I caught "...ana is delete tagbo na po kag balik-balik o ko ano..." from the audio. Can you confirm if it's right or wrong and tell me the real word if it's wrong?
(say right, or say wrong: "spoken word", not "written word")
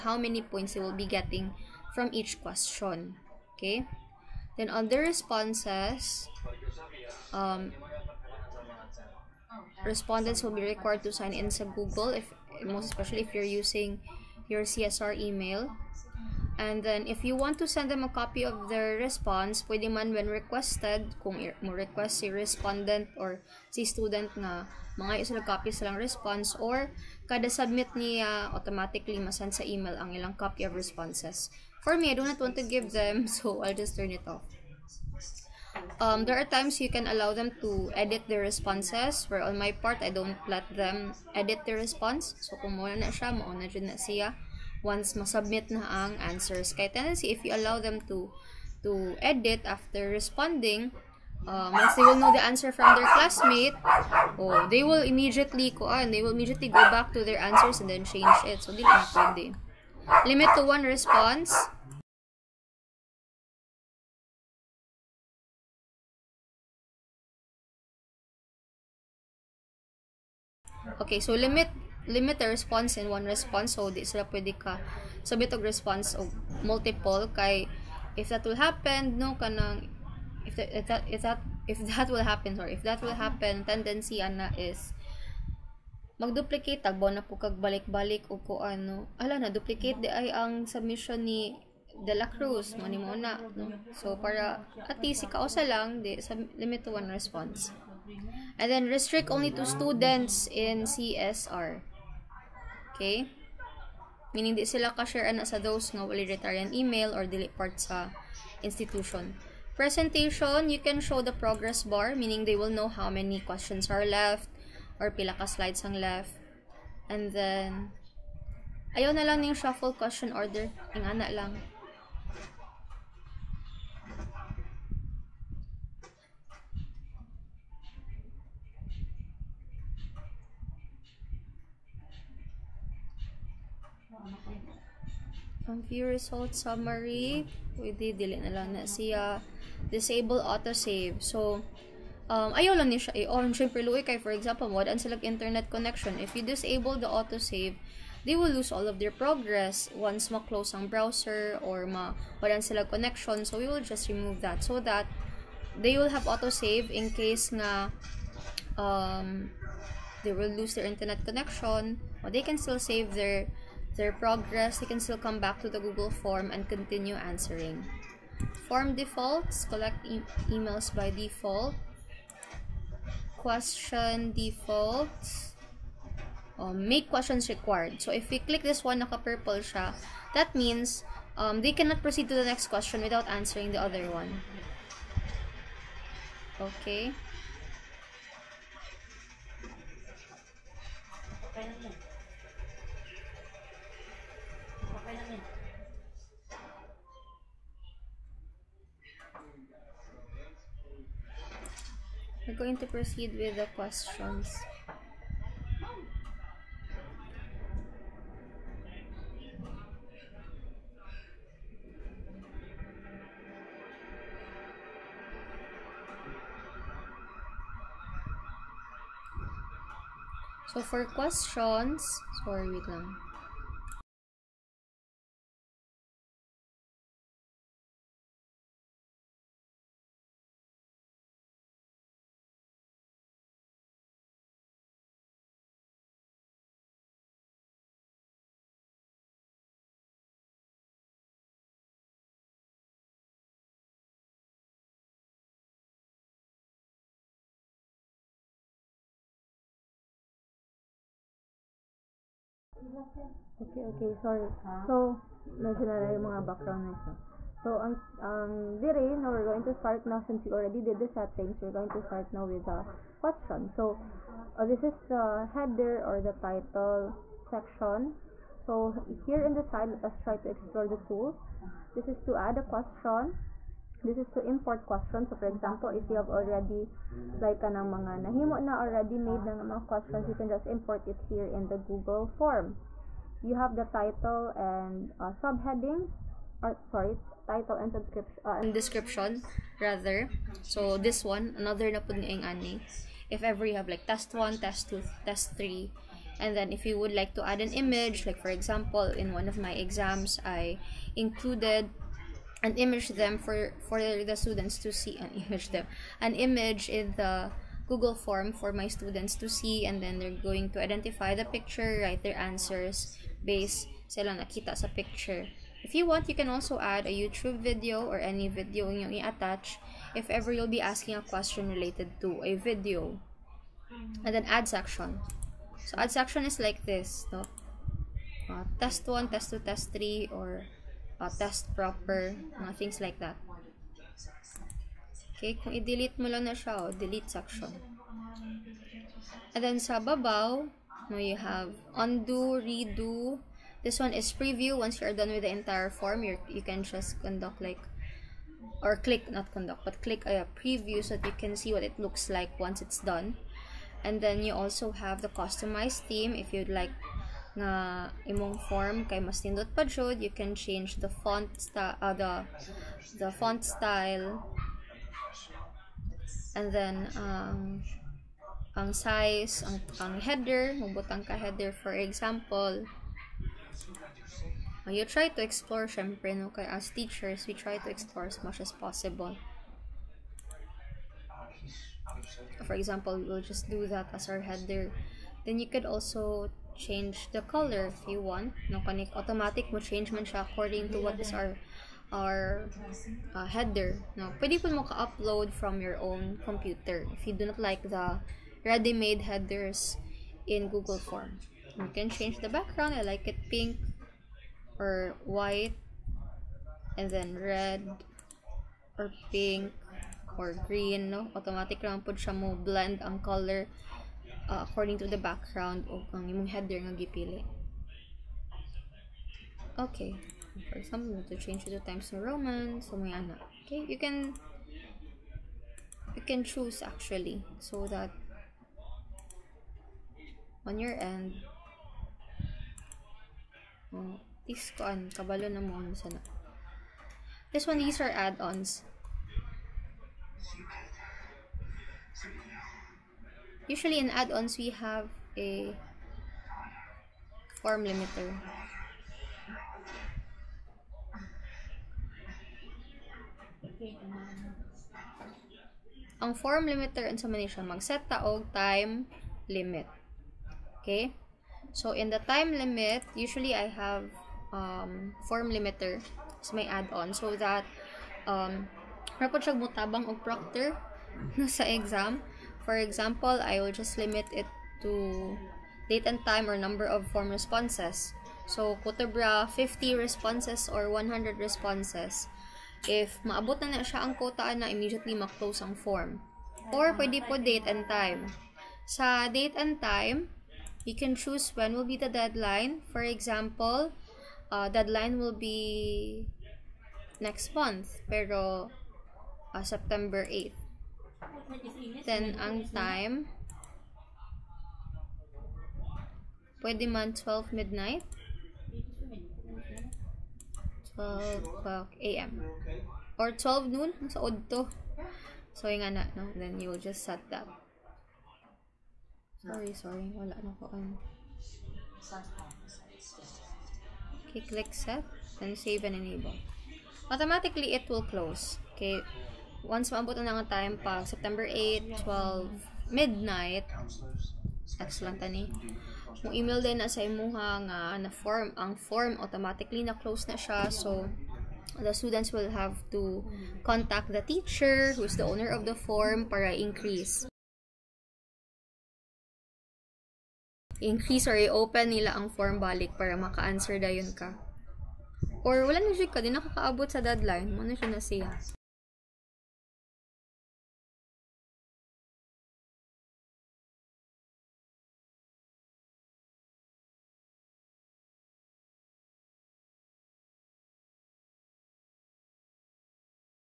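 wrong: "magduplicate", not "delete".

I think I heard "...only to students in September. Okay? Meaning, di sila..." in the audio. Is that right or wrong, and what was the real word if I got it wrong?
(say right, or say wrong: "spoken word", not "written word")
wrong: "CSR", not "September".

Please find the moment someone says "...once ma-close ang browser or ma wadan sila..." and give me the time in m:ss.
2:29.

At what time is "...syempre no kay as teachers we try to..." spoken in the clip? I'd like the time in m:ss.
6:15.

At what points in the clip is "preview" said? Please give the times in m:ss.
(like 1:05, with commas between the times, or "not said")
5:44, 5:50.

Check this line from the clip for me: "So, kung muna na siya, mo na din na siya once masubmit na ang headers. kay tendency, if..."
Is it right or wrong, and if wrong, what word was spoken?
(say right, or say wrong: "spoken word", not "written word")
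wrong: "answers", not "headers".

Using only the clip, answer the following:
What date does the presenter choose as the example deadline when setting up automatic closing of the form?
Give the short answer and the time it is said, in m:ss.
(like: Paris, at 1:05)
September 8, at 8:19.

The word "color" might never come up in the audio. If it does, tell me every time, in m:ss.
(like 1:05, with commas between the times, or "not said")
6:27, 6:53.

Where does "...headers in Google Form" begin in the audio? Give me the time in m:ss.
6:39.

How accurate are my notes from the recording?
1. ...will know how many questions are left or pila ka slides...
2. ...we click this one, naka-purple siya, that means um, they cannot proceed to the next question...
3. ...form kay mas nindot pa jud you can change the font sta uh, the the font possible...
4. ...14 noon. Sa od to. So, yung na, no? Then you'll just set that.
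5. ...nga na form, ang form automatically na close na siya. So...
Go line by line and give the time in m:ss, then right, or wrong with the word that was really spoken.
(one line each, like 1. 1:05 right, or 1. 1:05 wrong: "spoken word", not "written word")
1. 1:52 right
2. 2:58 right
3. 5:58 wrong: "style", not "possible"
4. 8:33 wrong: "12", not "14"
5. 8:57 right.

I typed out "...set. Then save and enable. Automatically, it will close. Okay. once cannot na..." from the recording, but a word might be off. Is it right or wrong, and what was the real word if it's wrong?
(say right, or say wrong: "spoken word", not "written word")
wrong: "maabot", not "cannot".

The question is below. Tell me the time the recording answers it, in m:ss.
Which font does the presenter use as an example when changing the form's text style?
7:01.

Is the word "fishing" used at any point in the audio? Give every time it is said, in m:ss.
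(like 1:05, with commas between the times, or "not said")
not said.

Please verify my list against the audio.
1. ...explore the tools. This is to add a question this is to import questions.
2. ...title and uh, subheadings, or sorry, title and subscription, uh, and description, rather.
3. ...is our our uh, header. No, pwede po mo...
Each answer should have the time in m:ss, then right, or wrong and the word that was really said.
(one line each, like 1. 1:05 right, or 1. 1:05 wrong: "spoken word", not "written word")
1. 4:30 right
2. 4:43 right
3. 6:31 right.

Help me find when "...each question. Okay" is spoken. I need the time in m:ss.
0:02.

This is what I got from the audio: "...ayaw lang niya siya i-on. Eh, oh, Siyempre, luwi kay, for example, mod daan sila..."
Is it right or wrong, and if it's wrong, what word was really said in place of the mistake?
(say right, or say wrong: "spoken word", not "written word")
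right.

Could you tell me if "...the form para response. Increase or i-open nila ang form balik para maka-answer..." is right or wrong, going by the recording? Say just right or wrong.
wrong.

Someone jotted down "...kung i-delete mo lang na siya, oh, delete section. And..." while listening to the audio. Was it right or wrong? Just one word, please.
right.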